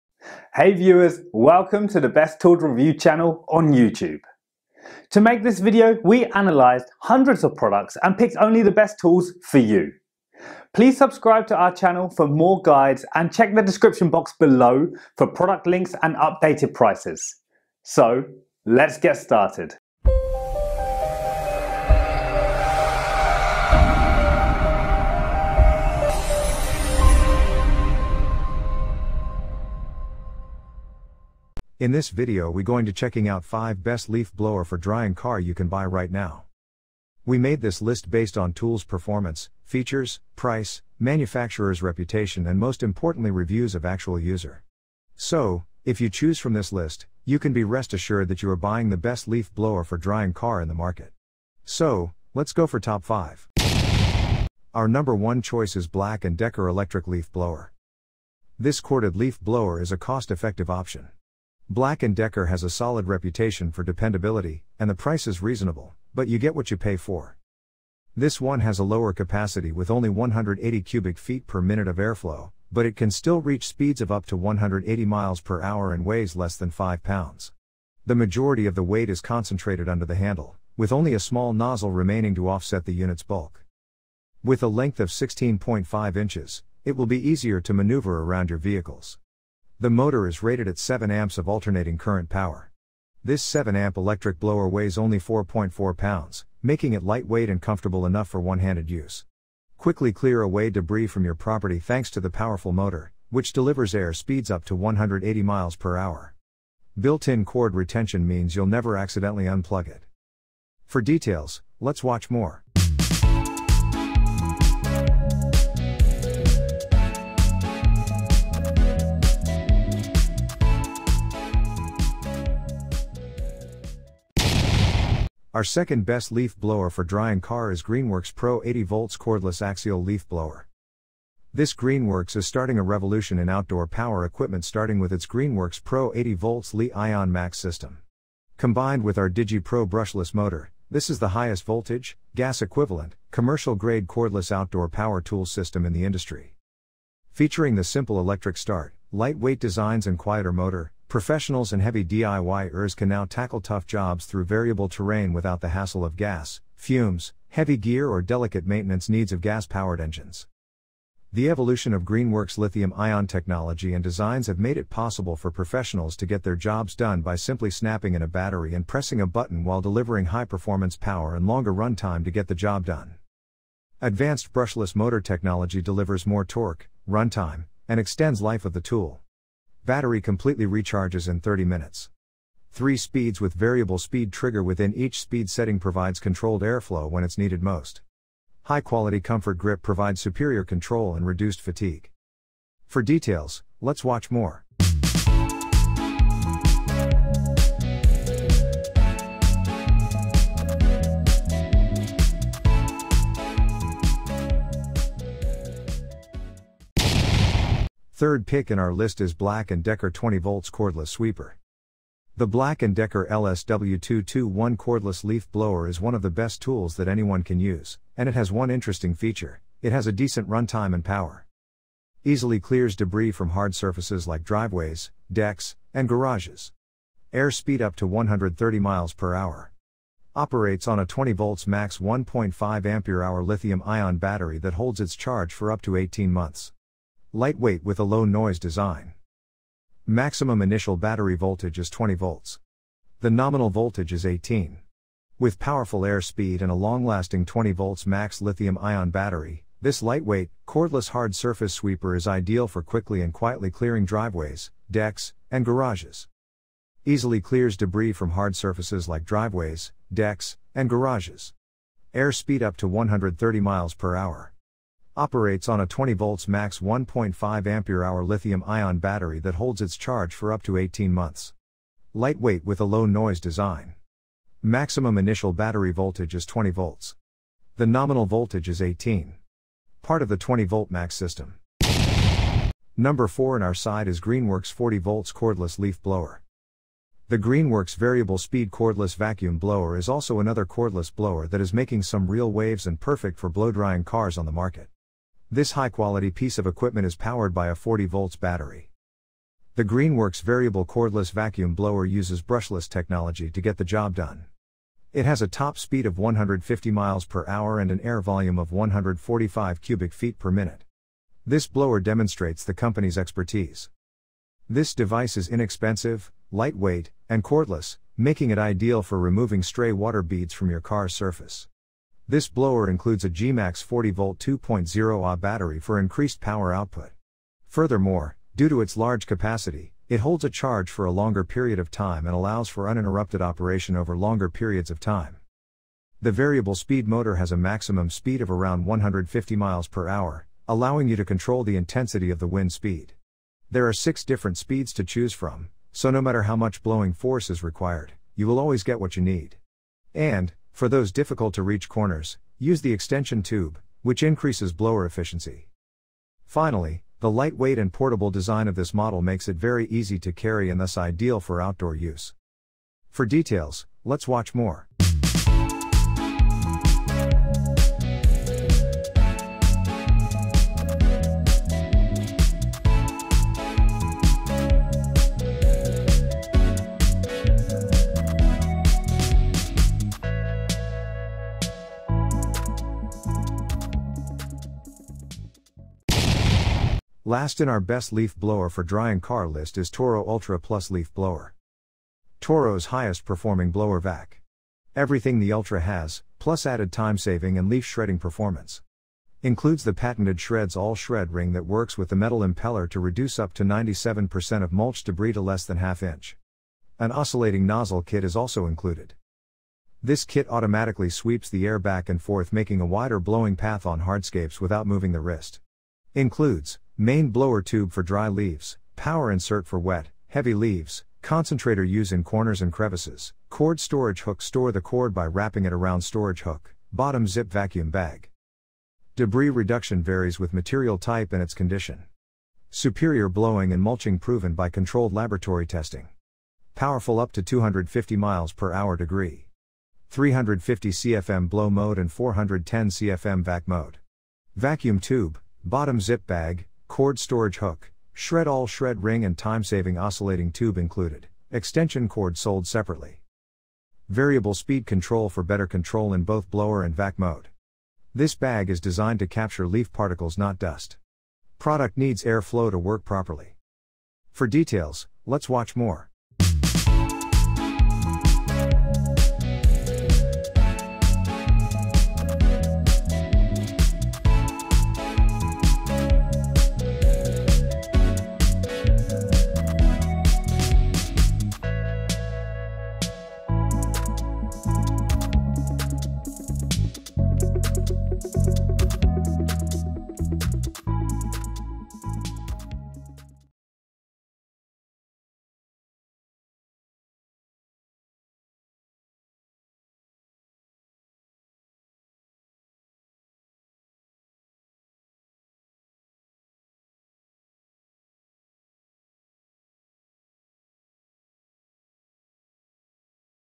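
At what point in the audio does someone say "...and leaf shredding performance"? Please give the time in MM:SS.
06:37.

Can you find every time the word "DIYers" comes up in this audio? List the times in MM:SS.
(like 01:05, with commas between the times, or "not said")
02:32.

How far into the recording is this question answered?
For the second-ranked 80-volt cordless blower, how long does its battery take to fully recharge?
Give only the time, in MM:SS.
03:01.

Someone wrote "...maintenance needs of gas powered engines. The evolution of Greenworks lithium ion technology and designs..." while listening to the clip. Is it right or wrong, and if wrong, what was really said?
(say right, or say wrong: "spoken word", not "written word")
right.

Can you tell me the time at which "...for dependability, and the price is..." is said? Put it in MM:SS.
01:03.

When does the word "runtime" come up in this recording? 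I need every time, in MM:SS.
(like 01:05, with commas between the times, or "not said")
02:57, 03:40.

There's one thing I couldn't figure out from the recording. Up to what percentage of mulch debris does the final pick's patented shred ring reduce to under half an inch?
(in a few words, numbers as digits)
97%.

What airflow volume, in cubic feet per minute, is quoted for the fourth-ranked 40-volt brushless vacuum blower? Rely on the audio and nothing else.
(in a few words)
145 cubic feet per minute.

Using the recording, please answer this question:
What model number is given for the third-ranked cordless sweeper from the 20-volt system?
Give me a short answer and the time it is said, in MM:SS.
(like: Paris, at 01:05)
LSW221, at 03:33.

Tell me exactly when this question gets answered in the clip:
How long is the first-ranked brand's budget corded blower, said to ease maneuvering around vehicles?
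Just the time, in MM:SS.
01:25.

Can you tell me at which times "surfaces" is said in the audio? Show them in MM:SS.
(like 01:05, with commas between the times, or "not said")
03:43, 04:11, 04:18, 05:21.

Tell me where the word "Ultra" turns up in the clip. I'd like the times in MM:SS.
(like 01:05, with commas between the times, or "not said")
06:30, 06:35.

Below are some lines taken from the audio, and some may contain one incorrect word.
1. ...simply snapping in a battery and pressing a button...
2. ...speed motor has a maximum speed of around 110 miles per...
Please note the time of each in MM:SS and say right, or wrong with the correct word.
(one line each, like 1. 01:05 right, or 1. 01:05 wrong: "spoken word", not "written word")
1. 02:47 right
2. 05:36 wrong: "150", not "110".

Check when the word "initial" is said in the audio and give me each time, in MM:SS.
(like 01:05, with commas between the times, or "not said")
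04:00, 04:35.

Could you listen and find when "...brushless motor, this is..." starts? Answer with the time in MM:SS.
02:19.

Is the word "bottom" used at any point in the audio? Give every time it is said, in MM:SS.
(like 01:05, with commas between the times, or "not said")
07:06, 07:25.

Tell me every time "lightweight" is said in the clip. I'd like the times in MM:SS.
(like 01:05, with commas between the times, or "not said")
01:37, 02:29, 03:57, 04:10, 04:32, 05:16, 05:57.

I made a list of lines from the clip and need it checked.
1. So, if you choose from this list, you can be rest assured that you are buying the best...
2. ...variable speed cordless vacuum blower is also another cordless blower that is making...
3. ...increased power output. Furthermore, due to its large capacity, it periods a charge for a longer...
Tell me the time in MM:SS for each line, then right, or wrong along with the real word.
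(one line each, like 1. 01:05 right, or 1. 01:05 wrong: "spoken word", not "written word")
1. 00:45 right
2. 04:47 right
3. 05:25 wrong: "holds", not "periods".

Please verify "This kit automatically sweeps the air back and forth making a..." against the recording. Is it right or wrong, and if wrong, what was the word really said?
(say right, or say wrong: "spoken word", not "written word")
right.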